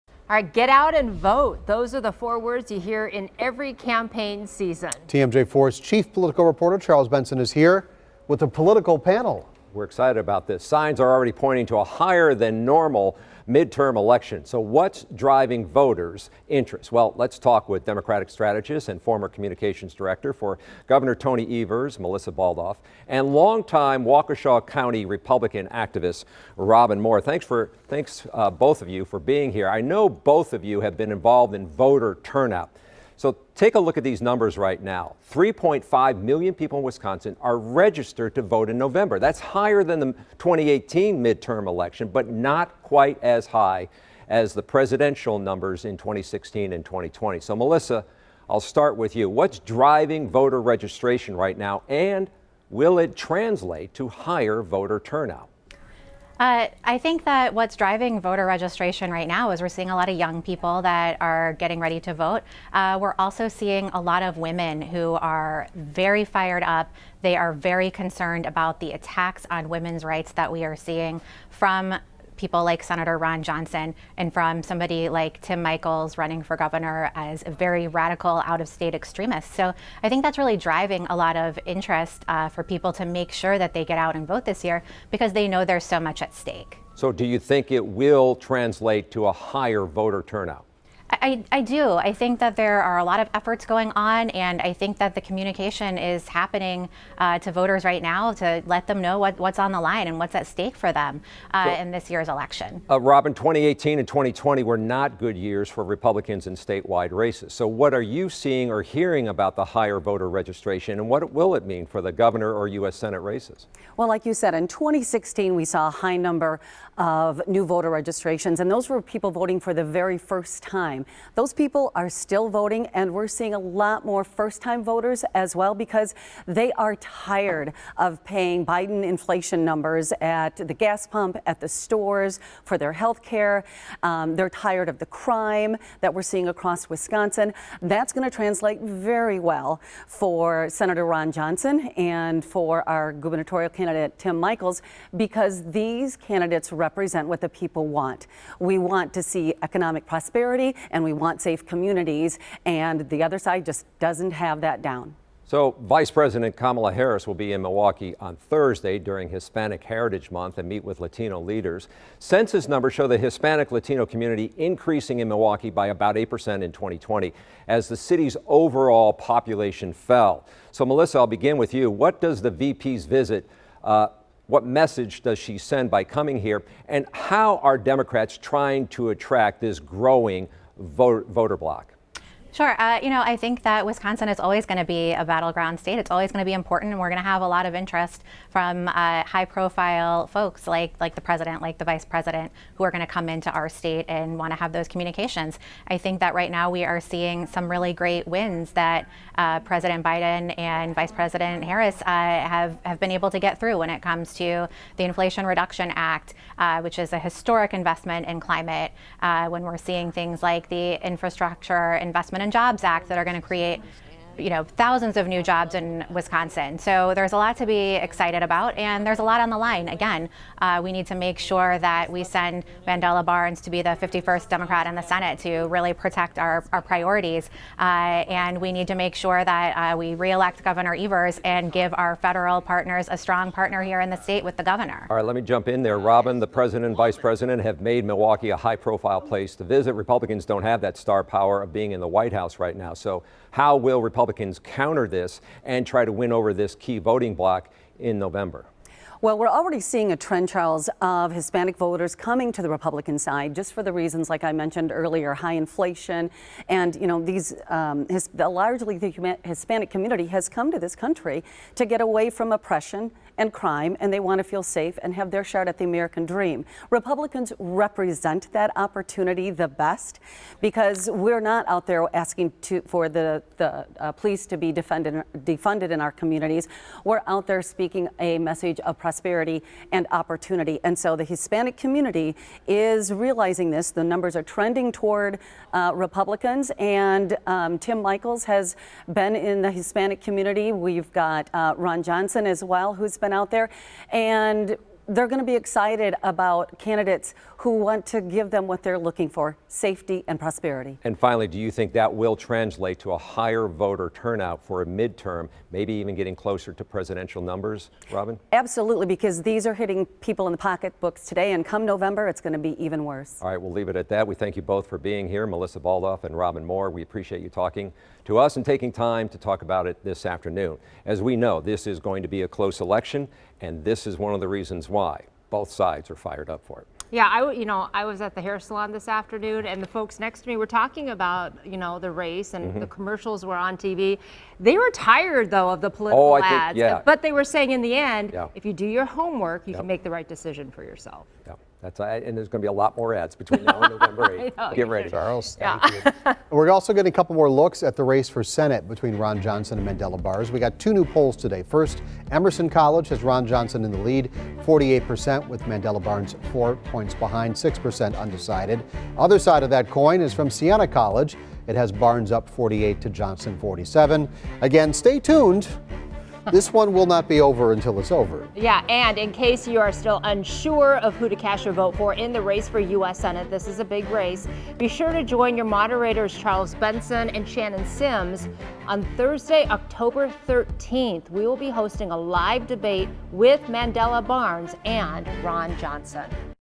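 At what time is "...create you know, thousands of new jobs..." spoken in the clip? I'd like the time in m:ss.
3:33.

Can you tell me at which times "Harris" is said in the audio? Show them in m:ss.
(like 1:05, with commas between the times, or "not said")
2:36, 3:21.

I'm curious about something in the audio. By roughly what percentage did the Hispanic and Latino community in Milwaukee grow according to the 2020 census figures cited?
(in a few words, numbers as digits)
8%.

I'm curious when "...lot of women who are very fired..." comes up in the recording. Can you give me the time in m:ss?
1:04.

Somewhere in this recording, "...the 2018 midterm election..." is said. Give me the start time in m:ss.
0:39.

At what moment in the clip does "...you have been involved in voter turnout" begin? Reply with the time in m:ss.
0:30.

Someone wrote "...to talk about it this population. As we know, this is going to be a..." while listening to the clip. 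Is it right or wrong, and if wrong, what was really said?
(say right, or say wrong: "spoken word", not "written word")
wrong: "afternoon", not "population".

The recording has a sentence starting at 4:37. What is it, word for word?
We're out there speaking a message of prosperity and opportunity.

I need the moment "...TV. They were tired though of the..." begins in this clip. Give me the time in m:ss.
5:33.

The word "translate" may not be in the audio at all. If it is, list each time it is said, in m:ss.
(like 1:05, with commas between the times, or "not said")
0:53, 1:28, 2:18, 5:02.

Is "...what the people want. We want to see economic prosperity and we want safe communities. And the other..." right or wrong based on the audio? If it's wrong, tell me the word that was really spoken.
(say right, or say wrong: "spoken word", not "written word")
right.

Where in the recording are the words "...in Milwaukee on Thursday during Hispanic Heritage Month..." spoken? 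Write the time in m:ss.
2:37.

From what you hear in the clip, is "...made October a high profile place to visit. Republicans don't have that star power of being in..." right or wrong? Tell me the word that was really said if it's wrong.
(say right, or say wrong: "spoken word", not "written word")
wrong: "Milwaukee", not "October".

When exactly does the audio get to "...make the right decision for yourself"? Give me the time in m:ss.
5:39.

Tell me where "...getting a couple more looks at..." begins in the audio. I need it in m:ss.
5:46.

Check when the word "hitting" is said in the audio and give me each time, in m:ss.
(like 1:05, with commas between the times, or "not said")
5:09.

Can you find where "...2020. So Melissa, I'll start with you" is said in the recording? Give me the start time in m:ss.
0:46.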